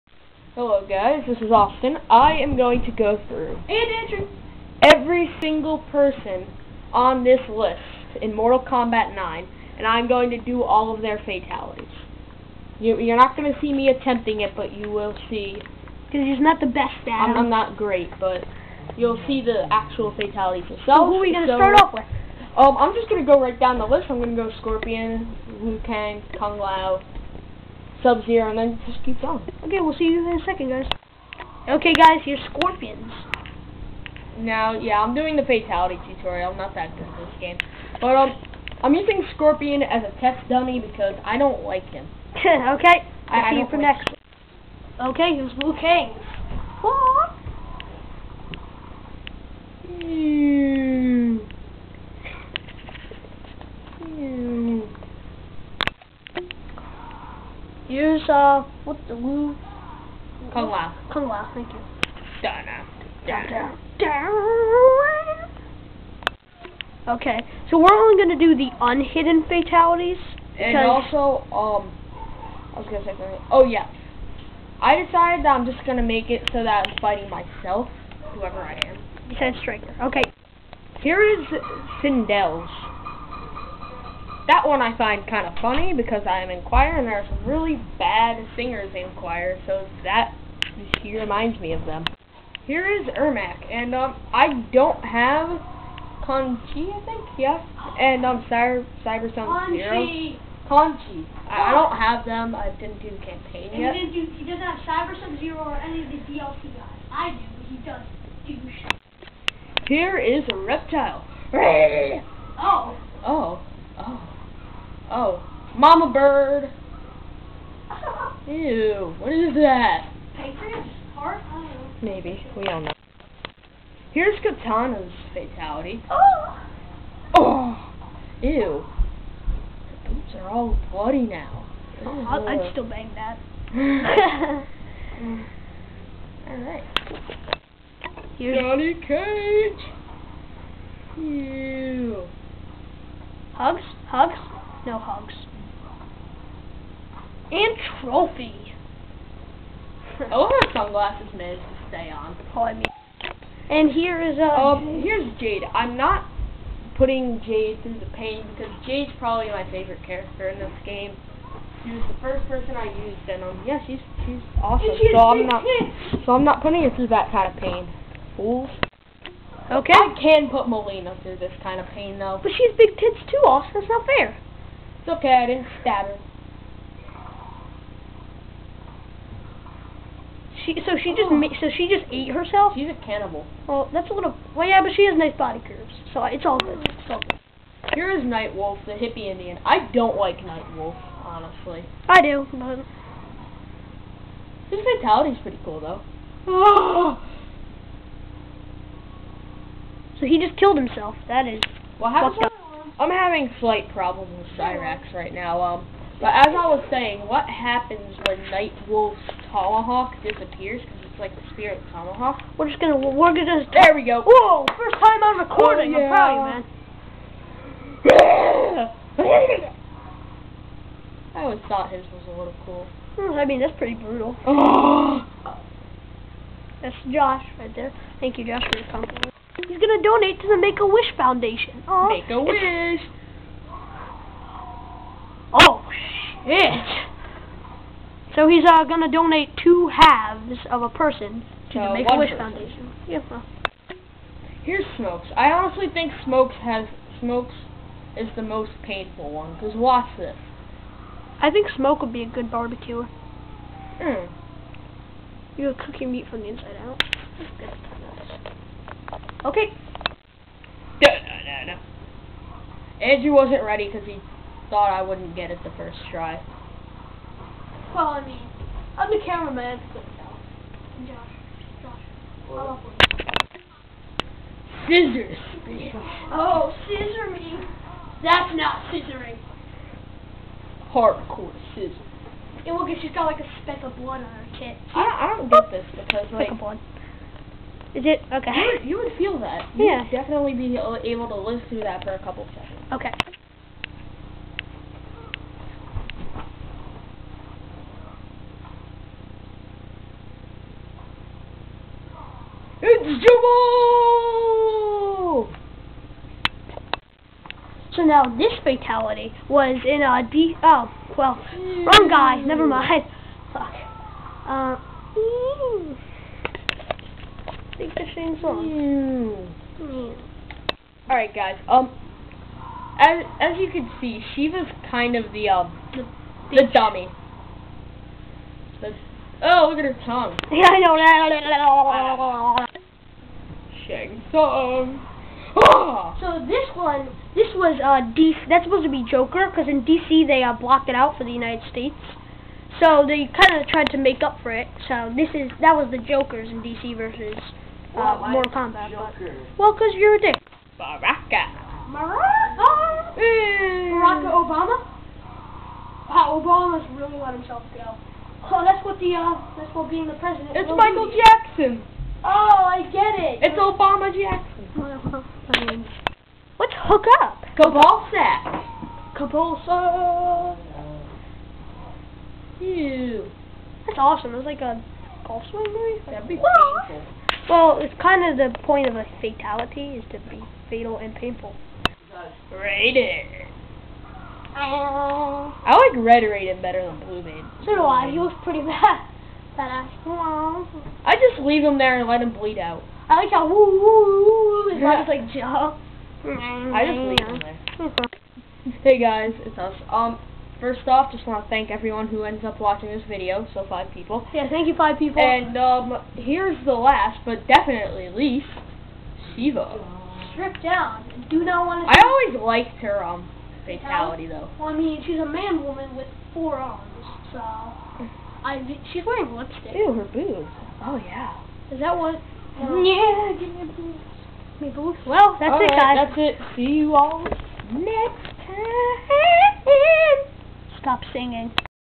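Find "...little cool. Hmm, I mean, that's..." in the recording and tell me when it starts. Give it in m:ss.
3:42.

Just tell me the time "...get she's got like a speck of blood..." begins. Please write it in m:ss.
4:42.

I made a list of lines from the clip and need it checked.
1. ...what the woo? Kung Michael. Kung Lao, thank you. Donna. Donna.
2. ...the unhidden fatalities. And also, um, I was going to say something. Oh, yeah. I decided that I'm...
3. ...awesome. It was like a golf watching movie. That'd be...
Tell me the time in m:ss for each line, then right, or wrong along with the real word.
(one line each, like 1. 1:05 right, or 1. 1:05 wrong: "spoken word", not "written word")
1. 0:58 wrong: "Lao", not "Michael"
2. 1:08 right
3. 6:13 wrong: "swing", not "watching".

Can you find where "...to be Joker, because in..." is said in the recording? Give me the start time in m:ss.
5:38.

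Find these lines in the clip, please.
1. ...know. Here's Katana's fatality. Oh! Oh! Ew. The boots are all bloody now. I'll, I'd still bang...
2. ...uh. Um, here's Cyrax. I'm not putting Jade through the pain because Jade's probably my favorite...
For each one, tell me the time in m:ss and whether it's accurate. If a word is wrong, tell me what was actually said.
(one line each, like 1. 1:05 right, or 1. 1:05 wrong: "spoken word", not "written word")
1. 2:02 right
2. 2:34 wrong: "Jade", not "Cyrax".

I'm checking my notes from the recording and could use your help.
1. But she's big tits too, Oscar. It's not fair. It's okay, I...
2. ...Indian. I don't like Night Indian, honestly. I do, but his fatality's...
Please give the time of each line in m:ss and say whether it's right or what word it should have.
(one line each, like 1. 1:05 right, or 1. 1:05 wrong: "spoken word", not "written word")
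1. 2:52 right
2. 3:09 wrong: "Wolf", not "Indian".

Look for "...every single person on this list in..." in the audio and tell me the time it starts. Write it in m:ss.
0:04.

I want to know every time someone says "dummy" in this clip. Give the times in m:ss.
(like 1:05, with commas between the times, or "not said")
0:40, 5:26.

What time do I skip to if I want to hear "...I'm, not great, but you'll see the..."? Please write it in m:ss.
0:17.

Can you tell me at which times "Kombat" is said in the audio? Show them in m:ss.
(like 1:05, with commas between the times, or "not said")
0:08, 5:48.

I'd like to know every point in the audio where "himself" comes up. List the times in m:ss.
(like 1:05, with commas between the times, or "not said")
3:20, 5:57.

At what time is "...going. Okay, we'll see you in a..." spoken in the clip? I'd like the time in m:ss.
0:29.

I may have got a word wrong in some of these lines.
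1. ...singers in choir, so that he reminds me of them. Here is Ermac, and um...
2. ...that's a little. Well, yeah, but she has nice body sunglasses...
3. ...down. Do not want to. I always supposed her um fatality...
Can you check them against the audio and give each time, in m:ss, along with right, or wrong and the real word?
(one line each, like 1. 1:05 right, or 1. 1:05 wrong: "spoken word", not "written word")
1. 1:28 right
2. 3:03 wrong: "curves", not "sunglasses"
3. 6:50 wrong: "liked", not "supposed".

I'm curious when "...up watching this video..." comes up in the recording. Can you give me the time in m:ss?
6:42.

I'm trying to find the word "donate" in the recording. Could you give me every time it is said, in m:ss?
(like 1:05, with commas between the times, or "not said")
3:50, 3:59.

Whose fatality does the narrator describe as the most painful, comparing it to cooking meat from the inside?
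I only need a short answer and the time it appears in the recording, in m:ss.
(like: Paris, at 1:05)
Smoke, at 4:07.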